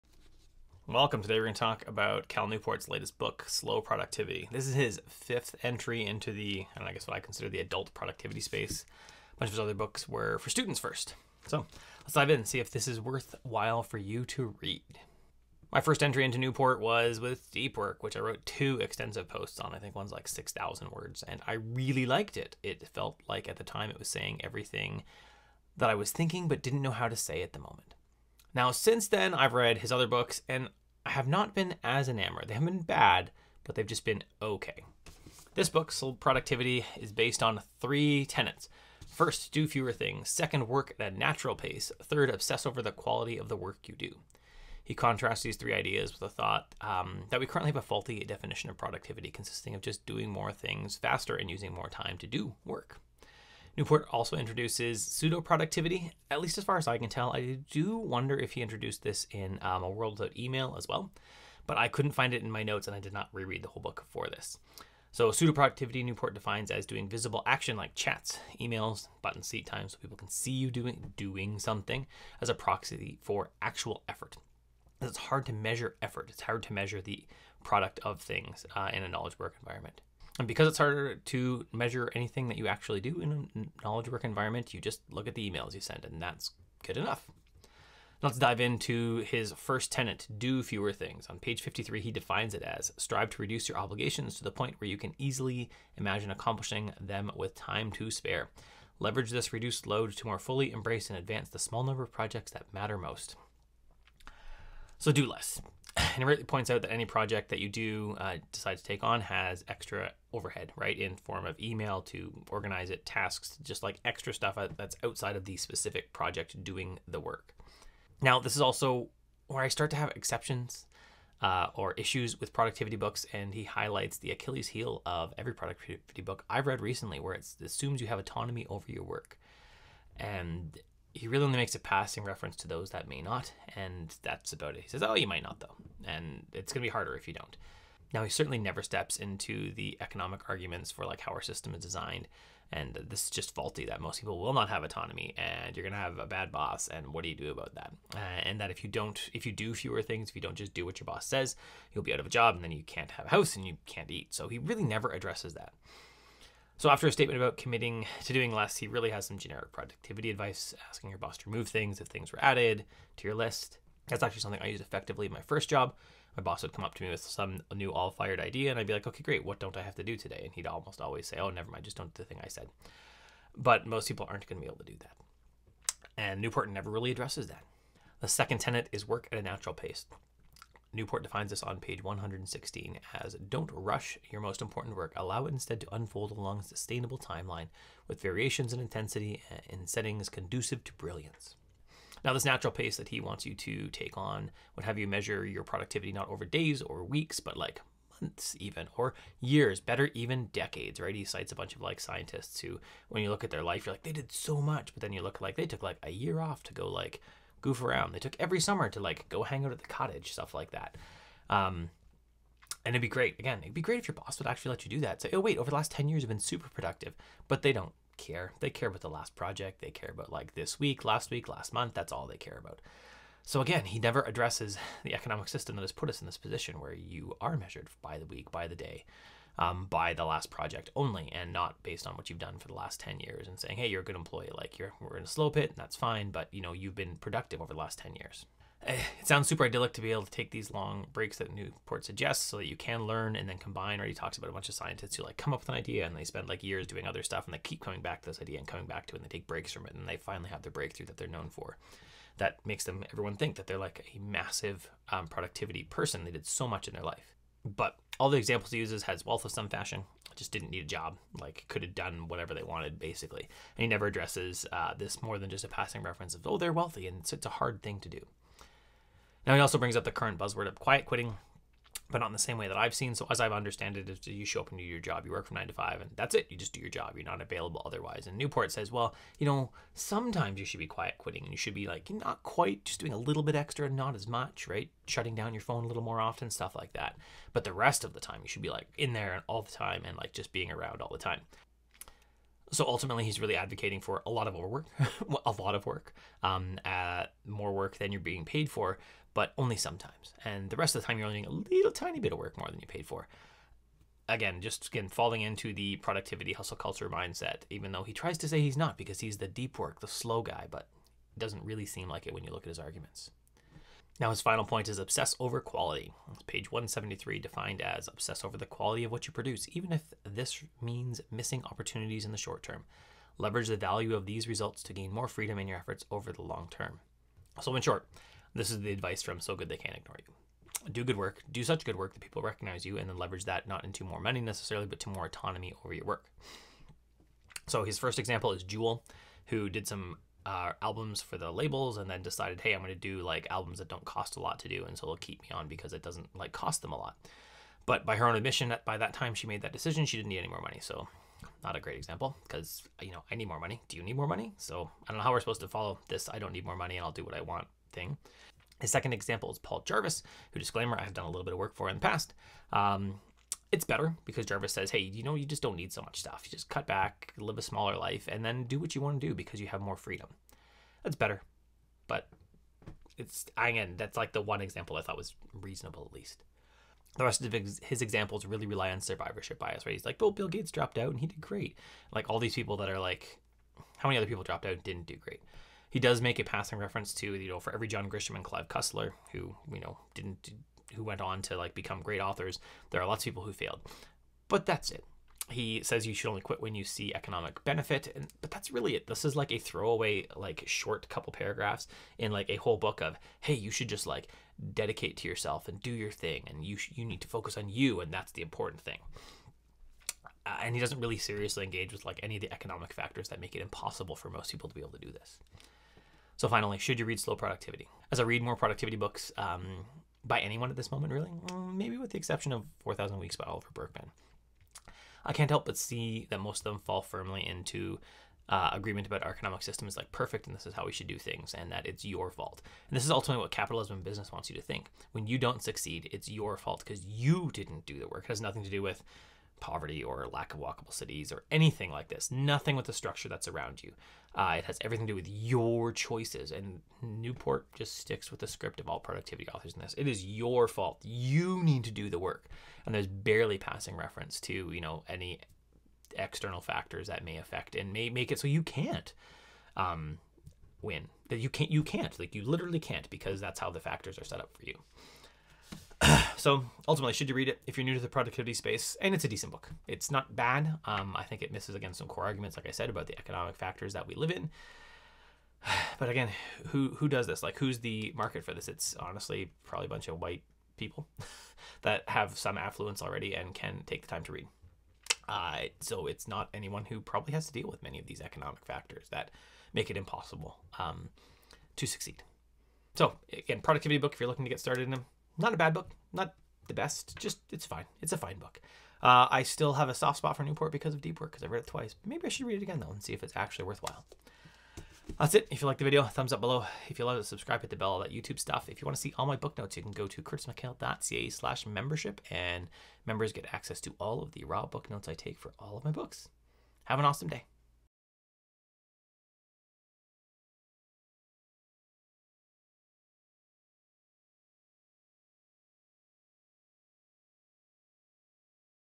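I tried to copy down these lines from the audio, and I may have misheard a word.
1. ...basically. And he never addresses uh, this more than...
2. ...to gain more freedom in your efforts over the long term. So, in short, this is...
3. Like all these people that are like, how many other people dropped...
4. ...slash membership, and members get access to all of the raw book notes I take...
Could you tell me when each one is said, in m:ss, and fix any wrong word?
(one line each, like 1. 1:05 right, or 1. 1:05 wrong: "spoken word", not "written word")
1. 4:22 right
2. 5:24 right
3. 6:22 right
4. 8:31 right.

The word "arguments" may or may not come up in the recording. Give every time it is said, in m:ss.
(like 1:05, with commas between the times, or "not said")
2:20, 5:12, 7:52.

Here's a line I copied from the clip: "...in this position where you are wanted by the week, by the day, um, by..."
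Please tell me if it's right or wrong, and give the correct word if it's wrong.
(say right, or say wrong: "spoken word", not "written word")
wrong: "measured", not "wanted".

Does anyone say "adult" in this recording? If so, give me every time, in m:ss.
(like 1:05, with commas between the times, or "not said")
0:07.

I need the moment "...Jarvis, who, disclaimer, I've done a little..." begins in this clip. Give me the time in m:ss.
5:59.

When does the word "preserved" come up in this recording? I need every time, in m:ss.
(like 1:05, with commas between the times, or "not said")
not said.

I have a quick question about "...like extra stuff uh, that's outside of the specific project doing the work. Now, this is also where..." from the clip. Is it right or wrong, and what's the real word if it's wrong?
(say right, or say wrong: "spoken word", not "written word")
right.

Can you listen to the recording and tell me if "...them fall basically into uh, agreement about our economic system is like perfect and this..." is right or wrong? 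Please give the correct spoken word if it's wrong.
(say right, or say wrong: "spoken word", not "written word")
wrong: "firmly", not "basically".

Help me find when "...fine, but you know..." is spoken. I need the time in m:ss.
3:55.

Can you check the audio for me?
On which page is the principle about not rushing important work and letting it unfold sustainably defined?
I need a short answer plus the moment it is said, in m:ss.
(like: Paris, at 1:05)
116, at 3:01.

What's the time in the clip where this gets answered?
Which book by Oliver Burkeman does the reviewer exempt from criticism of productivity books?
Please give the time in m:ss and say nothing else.
7:02.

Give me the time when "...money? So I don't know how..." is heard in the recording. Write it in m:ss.
5:54.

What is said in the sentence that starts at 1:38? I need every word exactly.
Leverage this reduced load to more fully embrace and advance the small number of projects that matter most.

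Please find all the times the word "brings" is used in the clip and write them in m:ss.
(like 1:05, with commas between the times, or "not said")
4:29.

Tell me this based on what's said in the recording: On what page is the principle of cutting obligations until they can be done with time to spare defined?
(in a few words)
53.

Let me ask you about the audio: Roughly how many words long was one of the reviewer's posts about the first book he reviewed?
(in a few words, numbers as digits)
6,000.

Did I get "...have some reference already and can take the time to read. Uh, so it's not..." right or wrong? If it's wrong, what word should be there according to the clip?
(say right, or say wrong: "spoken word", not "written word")
wrong: "affluence", not "reference".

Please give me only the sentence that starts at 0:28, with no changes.
Now, since then, I've read his other books, and have not been as enamored.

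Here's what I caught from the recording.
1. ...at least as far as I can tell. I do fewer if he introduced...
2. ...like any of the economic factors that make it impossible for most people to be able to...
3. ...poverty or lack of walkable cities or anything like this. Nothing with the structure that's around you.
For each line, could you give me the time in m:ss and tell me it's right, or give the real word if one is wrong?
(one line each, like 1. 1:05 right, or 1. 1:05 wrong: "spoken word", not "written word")
1. 0:56 wrong: "wonder", not "fewer"
2. 6:52 right
3. 7:19 right.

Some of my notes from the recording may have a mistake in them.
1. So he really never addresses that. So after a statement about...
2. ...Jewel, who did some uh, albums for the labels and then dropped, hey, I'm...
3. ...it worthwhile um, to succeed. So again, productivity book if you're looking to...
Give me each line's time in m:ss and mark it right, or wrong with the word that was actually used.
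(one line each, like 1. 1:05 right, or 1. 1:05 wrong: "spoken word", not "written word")
1. 2:34 right
2. 5:38 wrong: "decided", not "dropped"
3. 8:09 wrong: "impossible", not "worthwhile".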